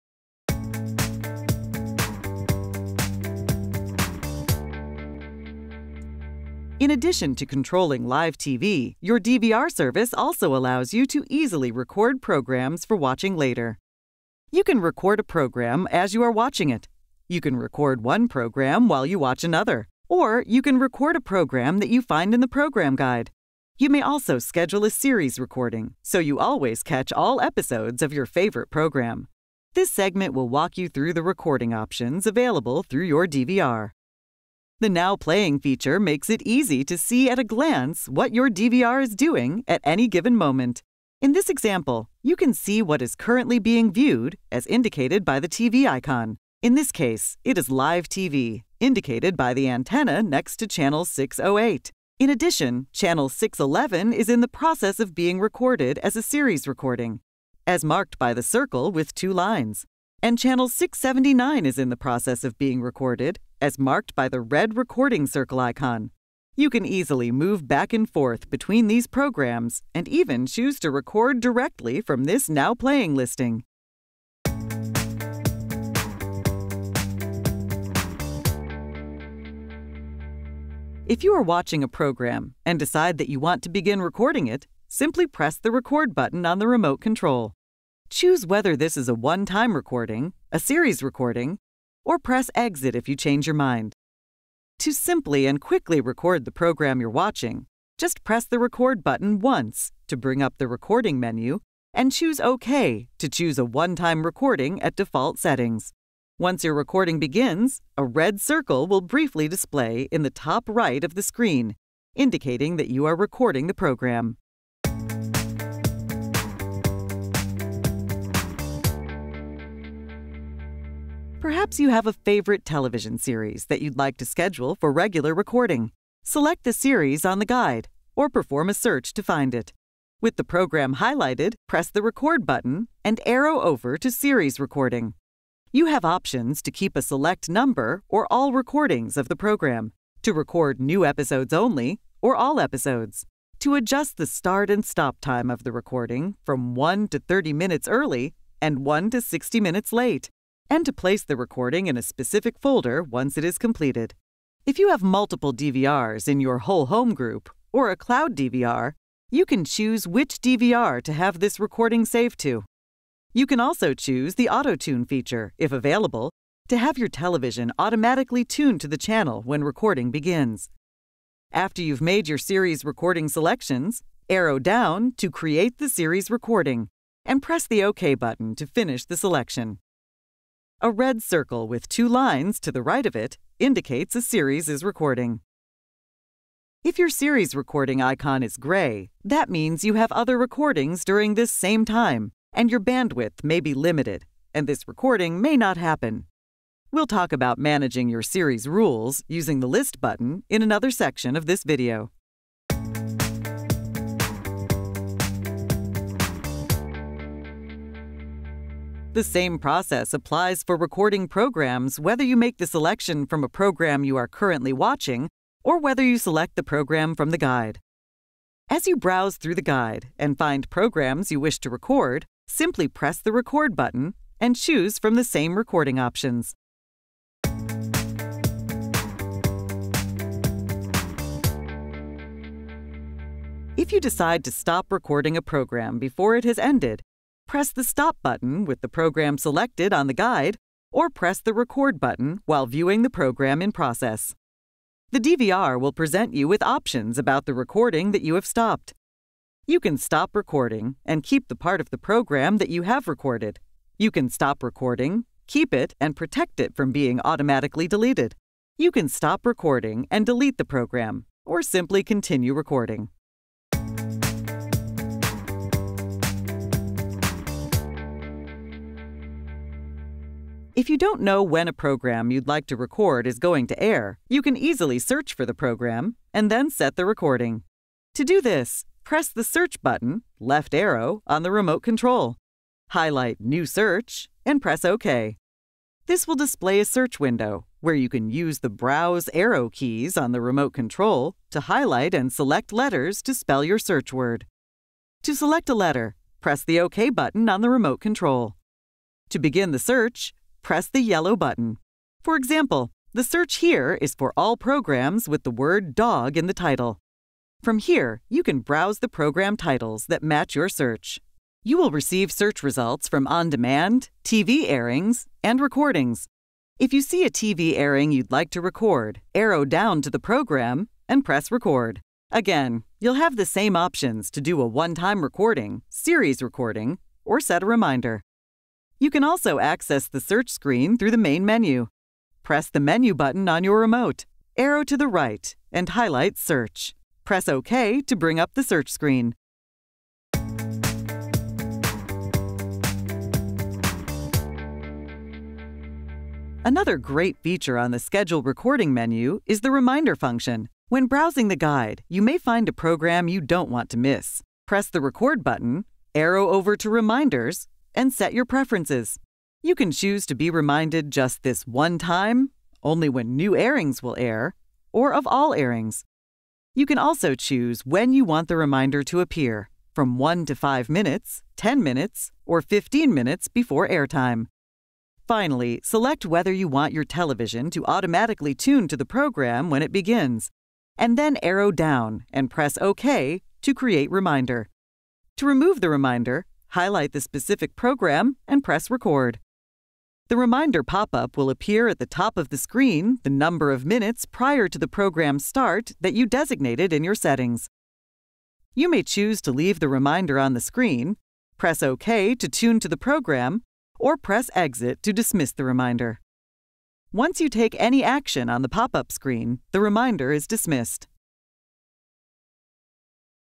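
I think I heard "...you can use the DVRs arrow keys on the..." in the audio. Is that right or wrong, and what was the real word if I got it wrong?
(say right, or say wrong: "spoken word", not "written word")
wrong: "Browse", not "DVRs".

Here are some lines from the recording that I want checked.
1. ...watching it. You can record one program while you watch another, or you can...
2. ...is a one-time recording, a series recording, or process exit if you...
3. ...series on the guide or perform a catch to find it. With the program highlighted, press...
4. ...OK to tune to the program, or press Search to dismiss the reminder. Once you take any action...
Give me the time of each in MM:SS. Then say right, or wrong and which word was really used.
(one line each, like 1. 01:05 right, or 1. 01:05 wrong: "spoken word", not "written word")
1. 00:16 right
2. 01:28 wrong: "press", not "process"
3. 02:06 wrong: "search", not "catch"
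4. 06:41 wrong: "Exit", not "Search".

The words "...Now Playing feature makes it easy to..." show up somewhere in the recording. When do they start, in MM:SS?
00:34.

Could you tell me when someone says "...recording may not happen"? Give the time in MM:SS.
03:14.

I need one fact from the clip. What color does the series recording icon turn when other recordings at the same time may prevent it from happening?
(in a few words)
gray.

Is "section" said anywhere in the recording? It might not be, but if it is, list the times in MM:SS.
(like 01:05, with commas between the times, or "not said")
03:20.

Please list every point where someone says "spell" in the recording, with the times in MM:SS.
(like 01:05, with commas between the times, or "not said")
04:53.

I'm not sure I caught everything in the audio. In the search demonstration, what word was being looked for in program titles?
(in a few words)
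dog.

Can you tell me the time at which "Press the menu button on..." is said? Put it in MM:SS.
05:32.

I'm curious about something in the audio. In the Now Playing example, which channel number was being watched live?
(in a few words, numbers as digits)
608.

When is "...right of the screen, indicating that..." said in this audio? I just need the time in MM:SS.
01:50.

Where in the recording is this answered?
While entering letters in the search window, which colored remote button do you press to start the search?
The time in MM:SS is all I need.
05:01.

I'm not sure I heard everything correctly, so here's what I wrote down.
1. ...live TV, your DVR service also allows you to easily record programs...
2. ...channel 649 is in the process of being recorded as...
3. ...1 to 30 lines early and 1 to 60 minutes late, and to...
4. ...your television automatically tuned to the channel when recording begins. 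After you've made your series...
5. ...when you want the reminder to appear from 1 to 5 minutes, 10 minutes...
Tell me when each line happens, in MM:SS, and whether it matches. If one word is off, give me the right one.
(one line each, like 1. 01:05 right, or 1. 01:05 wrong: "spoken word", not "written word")
1. 00:08 right
2. 01:00 wrong: "679", not "649"
3. 02:26 wrong: "minutes", not "lines"
4. 02:46 right
5. 06:07 right.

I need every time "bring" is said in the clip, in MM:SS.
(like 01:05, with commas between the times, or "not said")
01:40, 05:38.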